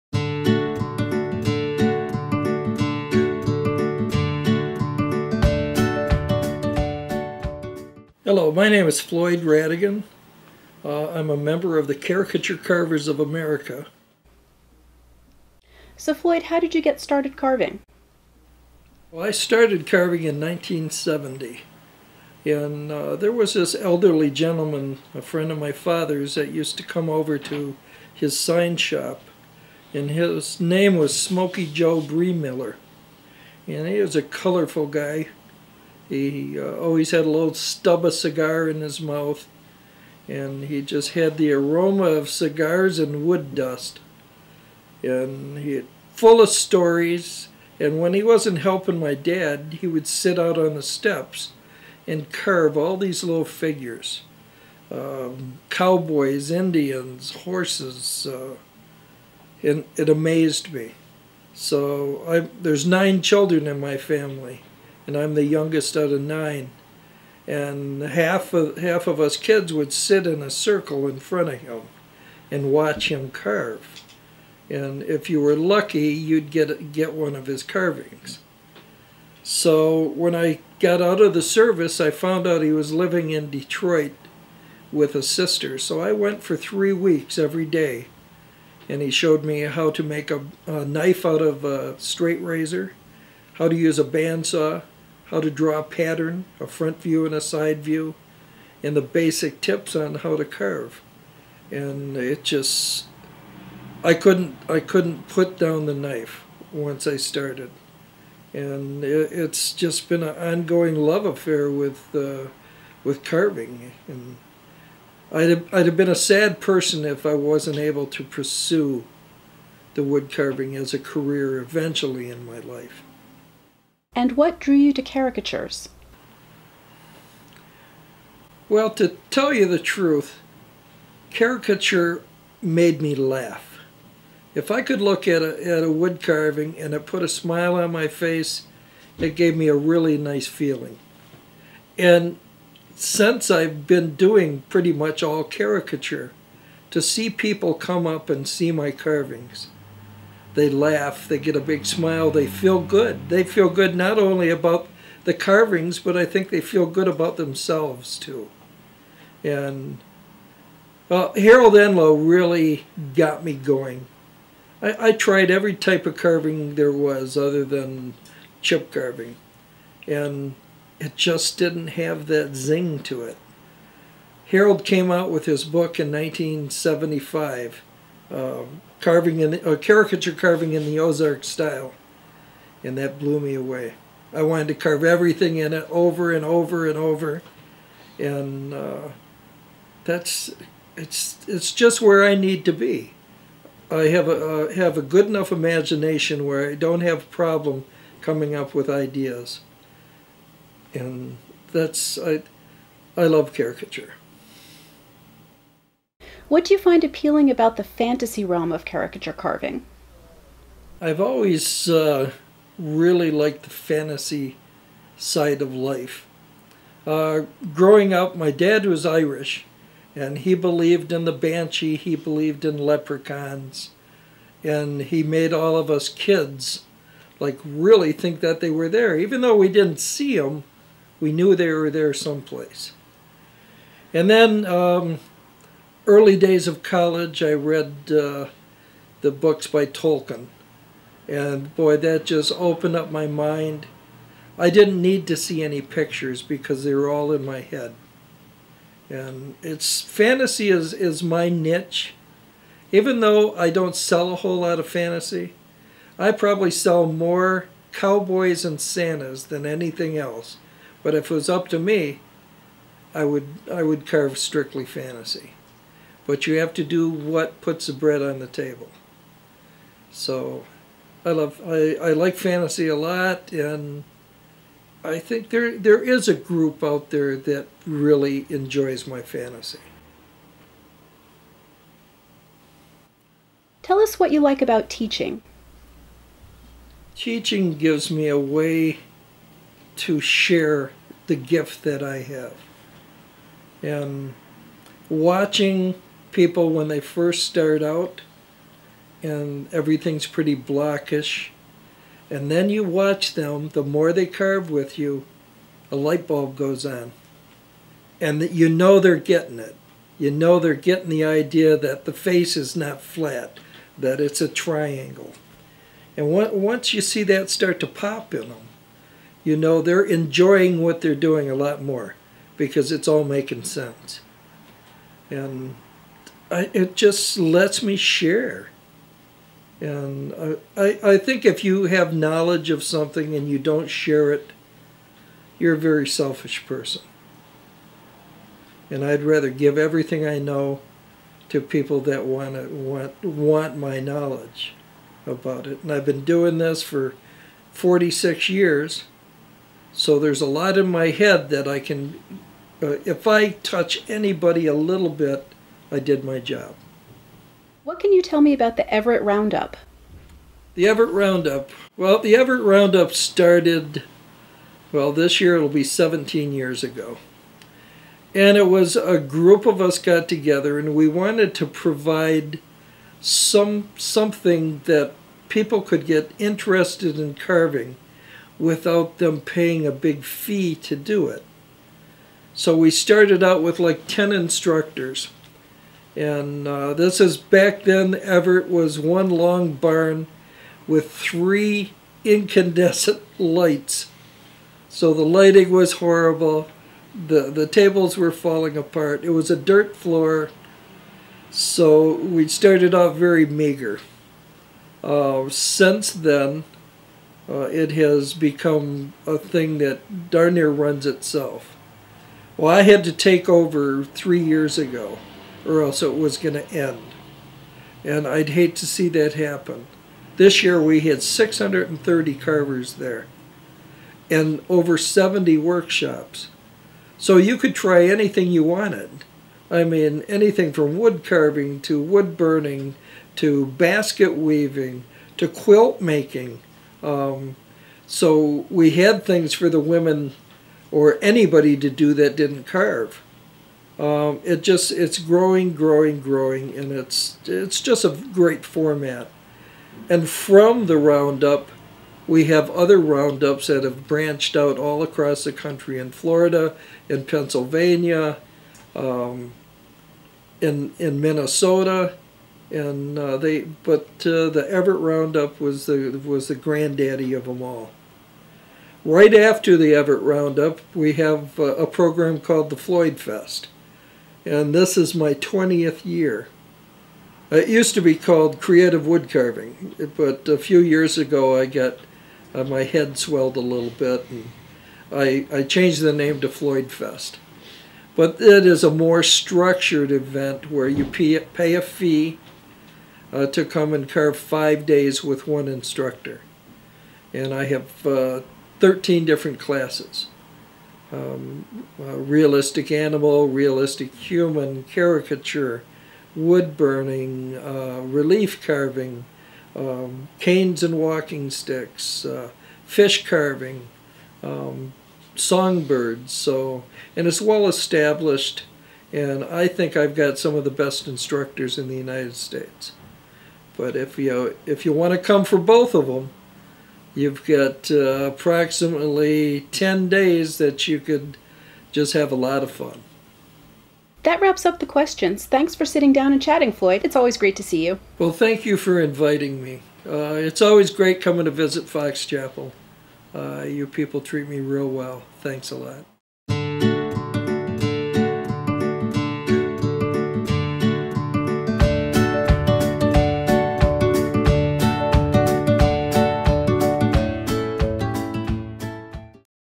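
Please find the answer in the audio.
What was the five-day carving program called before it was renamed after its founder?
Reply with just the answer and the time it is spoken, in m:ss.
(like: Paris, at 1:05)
Creative wood carving, at 7:58.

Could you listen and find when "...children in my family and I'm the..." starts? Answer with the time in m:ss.
1:03.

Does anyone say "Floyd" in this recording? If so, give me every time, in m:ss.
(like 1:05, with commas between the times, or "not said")
0:09, 0:16, 7:52, 8:06, 8:56.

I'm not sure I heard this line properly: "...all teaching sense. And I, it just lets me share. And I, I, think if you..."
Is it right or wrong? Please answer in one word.
wrong.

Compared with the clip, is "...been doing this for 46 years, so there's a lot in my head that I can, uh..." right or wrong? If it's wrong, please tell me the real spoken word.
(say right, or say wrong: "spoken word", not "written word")
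right.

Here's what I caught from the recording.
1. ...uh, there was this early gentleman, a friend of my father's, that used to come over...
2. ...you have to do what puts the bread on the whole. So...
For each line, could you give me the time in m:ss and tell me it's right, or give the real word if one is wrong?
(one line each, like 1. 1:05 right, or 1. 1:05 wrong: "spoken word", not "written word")
1. 0:22 wrong: "elderly", not "early"
2. 4:26 wrong: "table", not "whole".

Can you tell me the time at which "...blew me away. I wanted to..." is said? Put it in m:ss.
3:03.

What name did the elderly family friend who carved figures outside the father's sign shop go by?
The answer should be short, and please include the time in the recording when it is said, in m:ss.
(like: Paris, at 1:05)
Smoky Joe Breemiller, at 0:31.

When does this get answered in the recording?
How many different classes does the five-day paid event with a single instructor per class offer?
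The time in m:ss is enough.
8:18.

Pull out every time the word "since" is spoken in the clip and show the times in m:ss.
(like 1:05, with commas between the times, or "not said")
2:22, 6:45.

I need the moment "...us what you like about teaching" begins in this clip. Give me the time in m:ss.
4:43.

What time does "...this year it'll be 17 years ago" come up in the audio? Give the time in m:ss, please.
6:05.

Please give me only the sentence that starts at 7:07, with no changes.
So you could try anything you wanted.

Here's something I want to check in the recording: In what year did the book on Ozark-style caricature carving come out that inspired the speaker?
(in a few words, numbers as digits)
1975.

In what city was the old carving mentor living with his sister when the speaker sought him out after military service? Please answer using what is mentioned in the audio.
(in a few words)
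Detroit.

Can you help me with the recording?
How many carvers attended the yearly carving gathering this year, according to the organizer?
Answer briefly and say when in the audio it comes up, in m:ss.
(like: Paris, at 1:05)
630, at 7:01.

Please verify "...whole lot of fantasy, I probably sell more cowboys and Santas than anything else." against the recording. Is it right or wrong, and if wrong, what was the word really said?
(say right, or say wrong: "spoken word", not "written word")
right.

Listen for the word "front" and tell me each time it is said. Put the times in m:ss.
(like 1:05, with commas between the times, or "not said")
1:11, 1:36.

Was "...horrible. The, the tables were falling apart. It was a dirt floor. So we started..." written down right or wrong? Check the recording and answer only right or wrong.
right.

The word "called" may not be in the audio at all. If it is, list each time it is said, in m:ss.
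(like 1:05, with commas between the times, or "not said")
7:52, 7:58.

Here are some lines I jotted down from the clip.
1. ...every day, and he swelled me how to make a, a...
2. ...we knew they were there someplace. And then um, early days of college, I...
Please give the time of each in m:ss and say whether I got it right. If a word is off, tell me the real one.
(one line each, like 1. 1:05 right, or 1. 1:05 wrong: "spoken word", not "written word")
1. 1:27 wrong: "showed", not "swelled"
2. 3:51 right.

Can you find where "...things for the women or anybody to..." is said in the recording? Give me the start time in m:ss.
7:19.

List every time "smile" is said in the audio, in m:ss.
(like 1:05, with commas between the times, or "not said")
2:17, 2:31.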